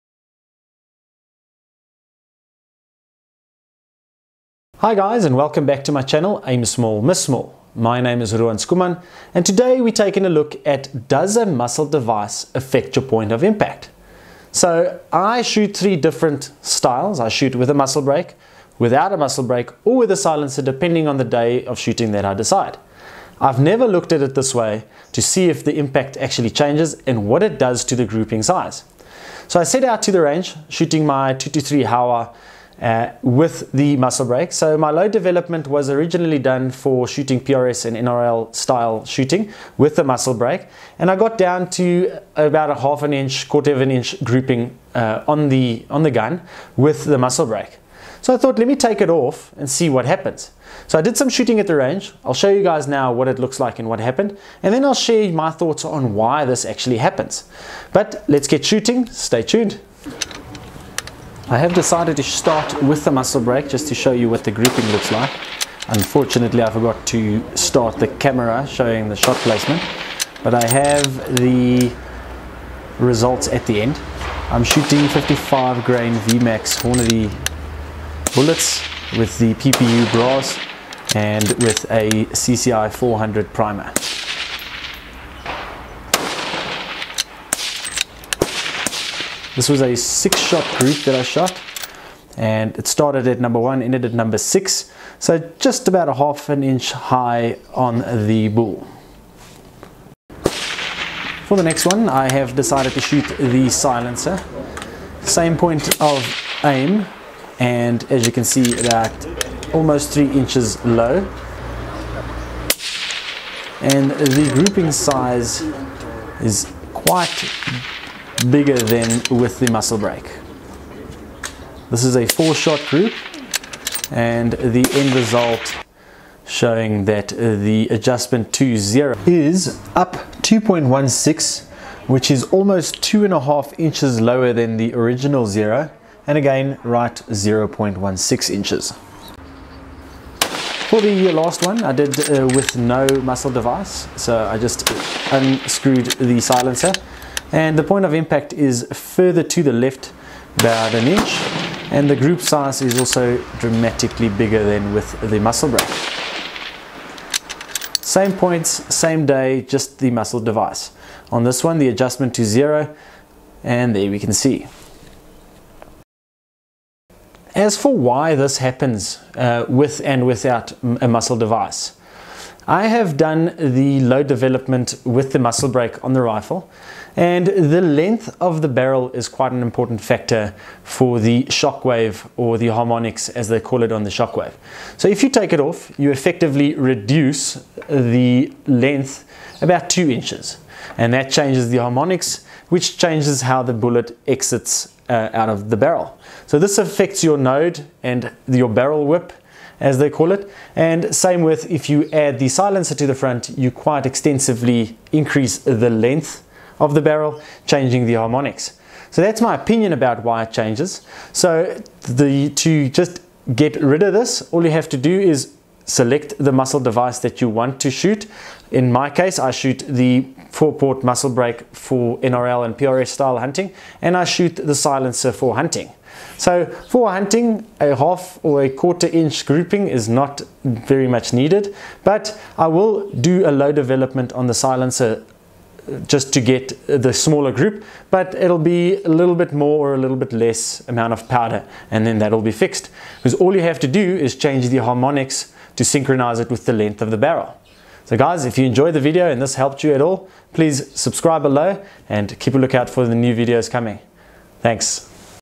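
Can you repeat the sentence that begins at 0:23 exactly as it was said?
I've never looked at it this way to see if the impact actually changes and what it does to the grouping size.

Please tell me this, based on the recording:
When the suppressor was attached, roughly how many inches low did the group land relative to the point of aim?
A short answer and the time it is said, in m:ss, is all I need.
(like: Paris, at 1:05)
3 inches, at 1:50.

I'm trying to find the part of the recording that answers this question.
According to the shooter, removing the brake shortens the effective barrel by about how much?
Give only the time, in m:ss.
3:09.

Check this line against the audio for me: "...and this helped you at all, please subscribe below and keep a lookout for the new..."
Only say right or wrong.
right.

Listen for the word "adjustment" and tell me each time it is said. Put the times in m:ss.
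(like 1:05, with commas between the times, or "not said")
2:07, 2:41.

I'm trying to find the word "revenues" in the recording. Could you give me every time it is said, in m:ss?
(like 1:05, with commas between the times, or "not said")
not said.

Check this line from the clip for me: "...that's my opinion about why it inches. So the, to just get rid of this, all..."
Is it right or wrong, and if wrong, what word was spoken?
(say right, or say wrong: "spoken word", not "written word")
wrong: "changes", not "inches".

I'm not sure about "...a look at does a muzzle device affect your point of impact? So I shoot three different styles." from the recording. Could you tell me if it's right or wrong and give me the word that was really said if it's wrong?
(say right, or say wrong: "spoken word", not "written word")
right.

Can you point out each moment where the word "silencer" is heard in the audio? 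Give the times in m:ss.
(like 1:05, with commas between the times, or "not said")
0:20, 1:43, 2:26, 3:22, 3:44, 3:54.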